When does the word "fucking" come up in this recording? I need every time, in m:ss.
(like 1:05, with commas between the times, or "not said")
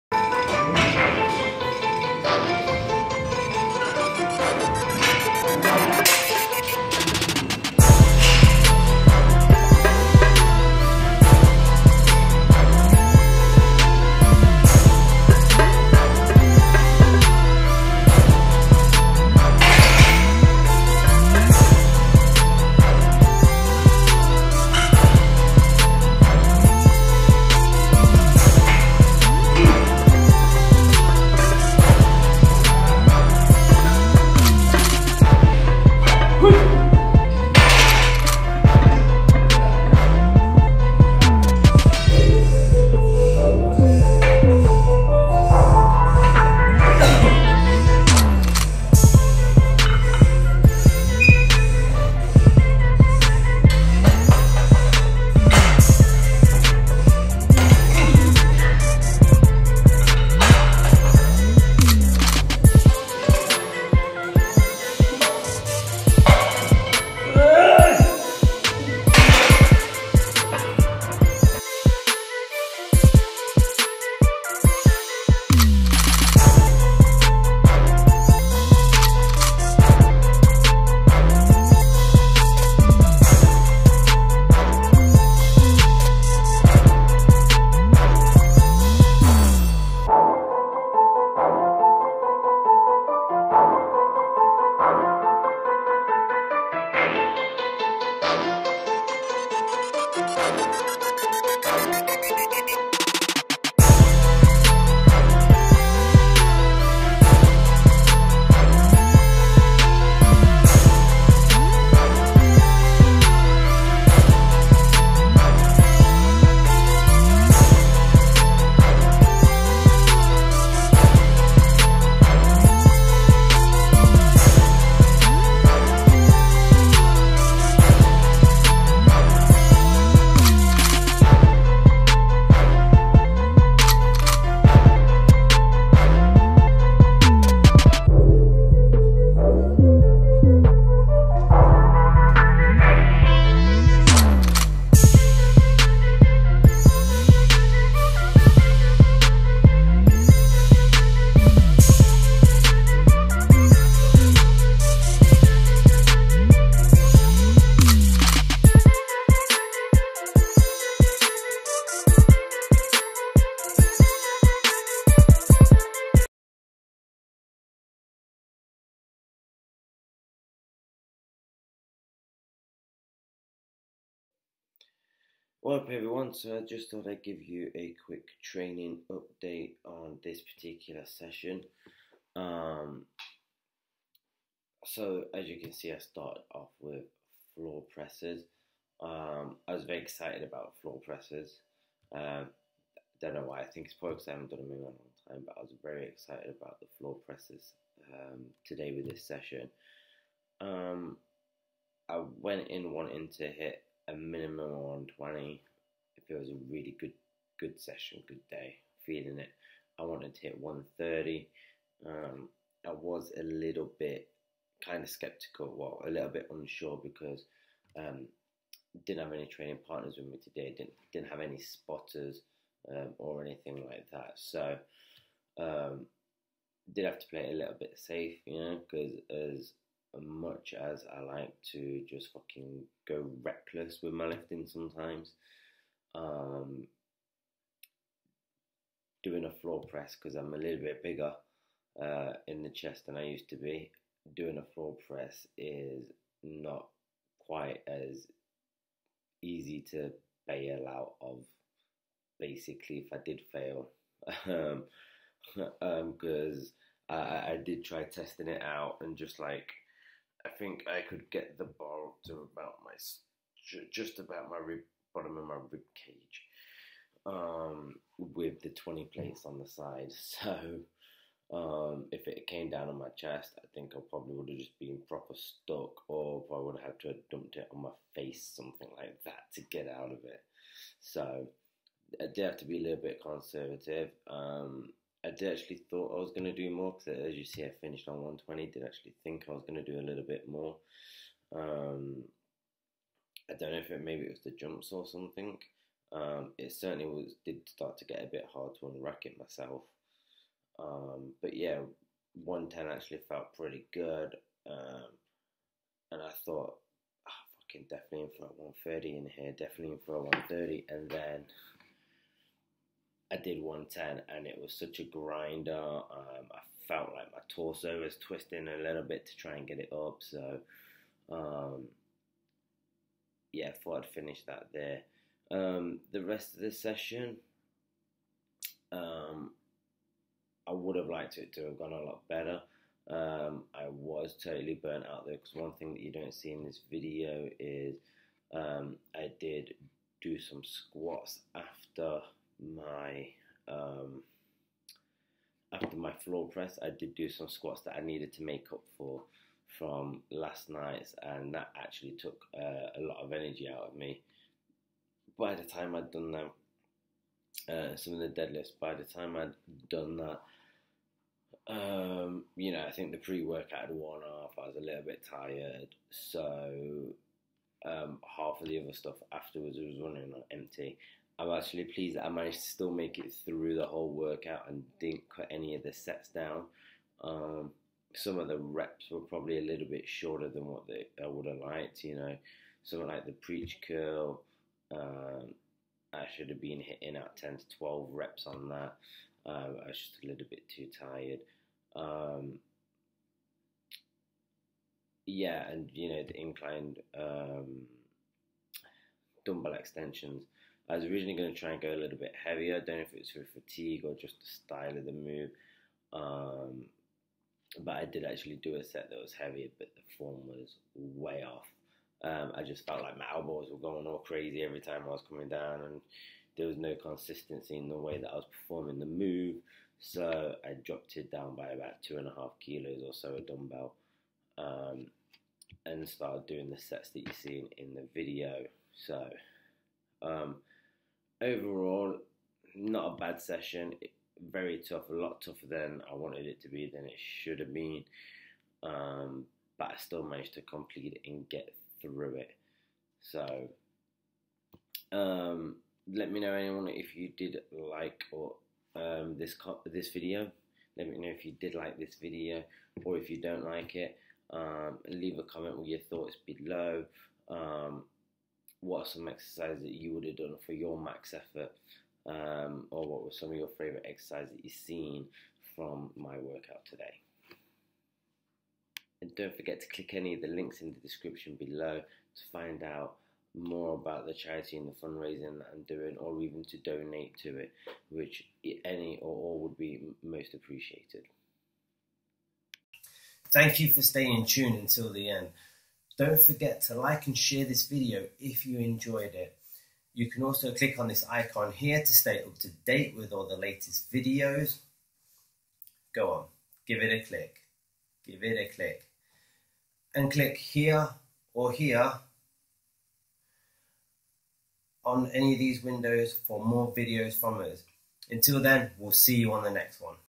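3:52, 5:07.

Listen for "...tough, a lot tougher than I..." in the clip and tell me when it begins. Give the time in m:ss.
7:14.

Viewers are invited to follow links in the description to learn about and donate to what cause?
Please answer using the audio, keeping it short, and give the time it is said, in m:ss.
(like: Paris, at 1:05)
Charity, at 7:54.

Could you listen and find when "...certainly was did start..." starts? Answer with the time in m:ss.
4:56.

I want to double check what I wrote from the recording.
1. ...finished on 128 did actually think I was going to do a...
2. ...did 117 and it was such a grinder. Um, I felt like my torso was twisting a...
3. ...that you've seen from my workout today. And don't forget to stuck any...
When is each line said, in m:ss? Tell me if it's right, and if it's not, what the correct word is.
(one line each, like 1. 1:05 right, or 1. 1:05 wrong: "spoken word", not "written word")
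1. 4:47 wrong: "120", not "128"
2. 5:13 wrong: "110", not "117"
3. 7:44 wrong: "click", not "stuck".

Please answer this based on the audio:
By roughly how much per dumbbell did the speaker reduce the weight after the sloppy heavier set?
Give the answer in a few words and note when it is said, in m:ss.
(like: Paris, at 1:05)
2.5 kilos, at 7:02.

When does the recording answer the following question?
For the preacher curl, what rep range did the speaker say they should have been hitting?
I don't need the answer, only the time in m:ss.
6:27.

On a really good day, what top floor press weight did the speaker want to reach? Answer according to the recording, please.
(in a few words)
130.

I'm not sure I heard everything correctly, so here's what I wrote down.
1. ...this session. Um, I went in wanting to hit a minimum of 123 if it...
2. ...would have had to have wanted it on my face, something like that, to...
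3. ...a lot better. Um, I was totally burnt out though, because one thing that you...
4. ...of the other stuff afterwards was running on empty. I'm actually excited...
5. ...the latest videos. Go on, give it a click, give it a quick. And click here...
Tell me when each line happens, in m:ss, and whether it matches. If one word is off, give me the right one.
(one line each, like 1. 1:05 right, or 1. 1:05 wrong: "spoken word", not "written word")
1. 3:19 wrong: "120", not "123"
2. 4:36 wrong: "dumped", not "wanted"
3. 5:31 right
4. 6:08 wrong: "pleased", not "excited"
5. 8:13 wrong: "click", not "quick".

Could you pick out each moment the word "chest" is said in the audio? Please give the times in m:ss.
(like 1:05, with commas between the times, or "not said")
4:02, 4:33.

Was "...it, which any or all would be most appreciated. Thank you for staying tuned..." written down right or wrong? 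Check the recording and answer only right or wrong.
right.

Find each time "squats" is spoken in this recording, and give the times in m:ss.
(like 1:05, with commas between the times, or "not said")
5:40, 5:47.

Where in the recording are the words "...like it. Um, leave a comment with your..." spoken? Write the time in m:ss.
7:33.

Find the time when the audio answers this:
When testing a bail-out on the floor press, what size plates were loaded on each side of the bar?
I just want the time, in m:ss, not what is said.
4:28.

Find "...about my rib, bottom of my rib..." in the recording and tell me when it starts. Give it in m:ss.
4:24.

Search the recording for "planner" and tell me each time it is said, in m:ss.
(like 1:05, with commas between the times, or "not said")
not said.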